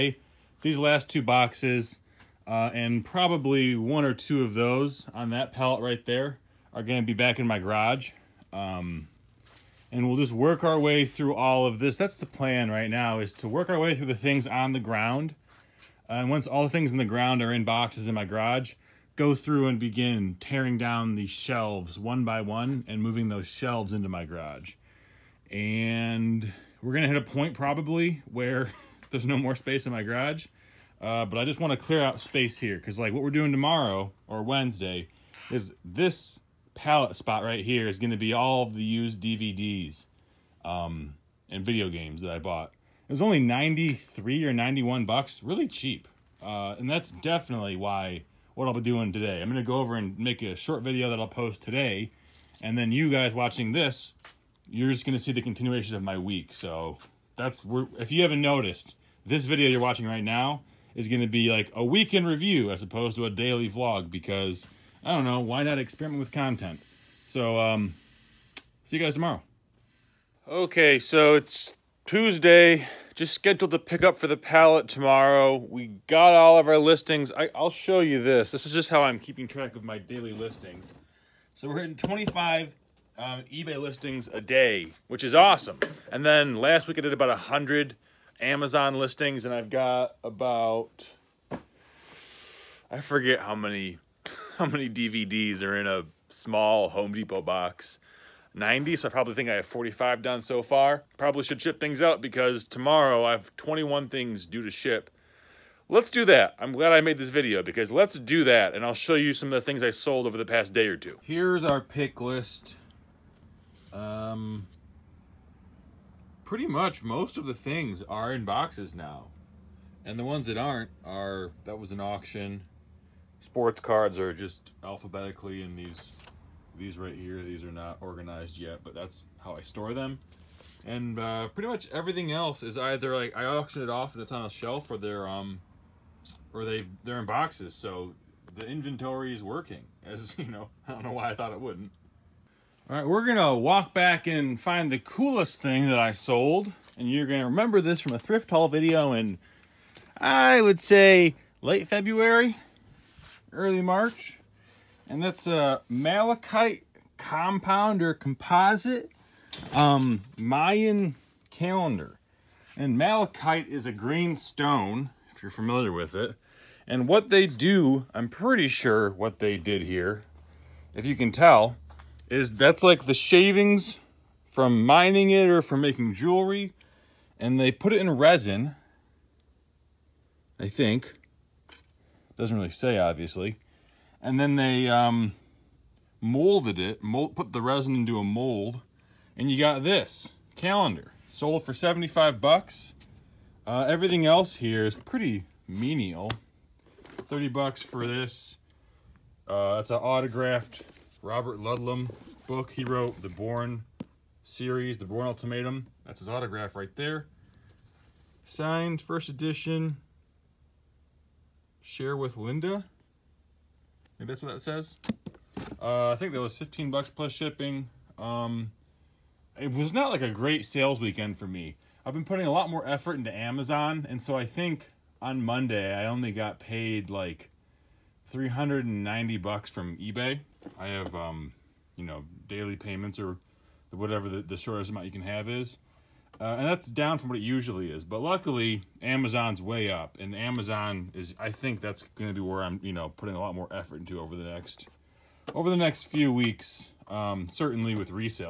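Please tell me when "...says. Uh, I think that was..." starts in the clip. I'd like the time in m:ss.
3:34.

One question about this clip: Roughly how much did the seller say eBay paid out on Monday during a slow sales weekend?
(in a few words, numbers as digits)
$390.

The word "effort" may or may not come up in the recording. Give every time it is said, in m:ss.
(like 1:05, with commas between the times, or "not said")
3:42, 4:03.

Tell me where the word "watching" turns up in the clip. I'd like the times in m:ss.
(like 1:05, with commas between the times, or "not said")
0:53, 0:59.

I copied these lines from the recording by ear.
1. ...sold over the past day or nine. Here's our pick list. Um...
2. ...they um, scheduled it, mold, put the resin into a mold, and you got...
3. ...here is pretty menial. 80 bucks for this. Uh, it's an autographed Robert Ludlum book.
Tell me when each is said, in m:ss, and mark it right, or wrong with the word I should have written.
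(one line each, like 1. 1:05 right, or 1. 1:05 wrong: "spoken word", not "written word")
1. 1:49 wrong: "two", not "nine"
2. 3:04 wrong: "molded", not "scheduled"
3. 3:14 wrong: "30", not "80".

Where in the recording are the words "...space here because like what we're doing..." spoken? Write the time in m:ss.
0:32.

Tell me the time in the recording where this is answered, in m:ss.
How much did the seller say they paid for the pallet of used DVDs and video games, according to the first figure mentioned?
0:43.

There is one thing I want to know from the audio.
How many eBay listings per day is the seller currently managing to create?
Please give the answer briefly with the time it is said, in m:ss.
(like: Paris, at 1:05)
25, at 1:21.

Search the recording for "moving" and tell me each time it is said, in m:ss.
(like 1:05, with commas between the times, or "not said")
0:23.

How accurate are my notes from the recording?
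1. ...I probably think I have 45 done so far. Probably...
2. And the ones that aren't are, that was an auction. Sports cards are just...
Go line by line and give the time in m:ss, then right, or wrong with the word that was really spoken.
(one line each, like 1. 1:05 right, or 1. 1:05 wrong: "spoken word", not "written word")
1. 1:39 right
2. 2:00 right.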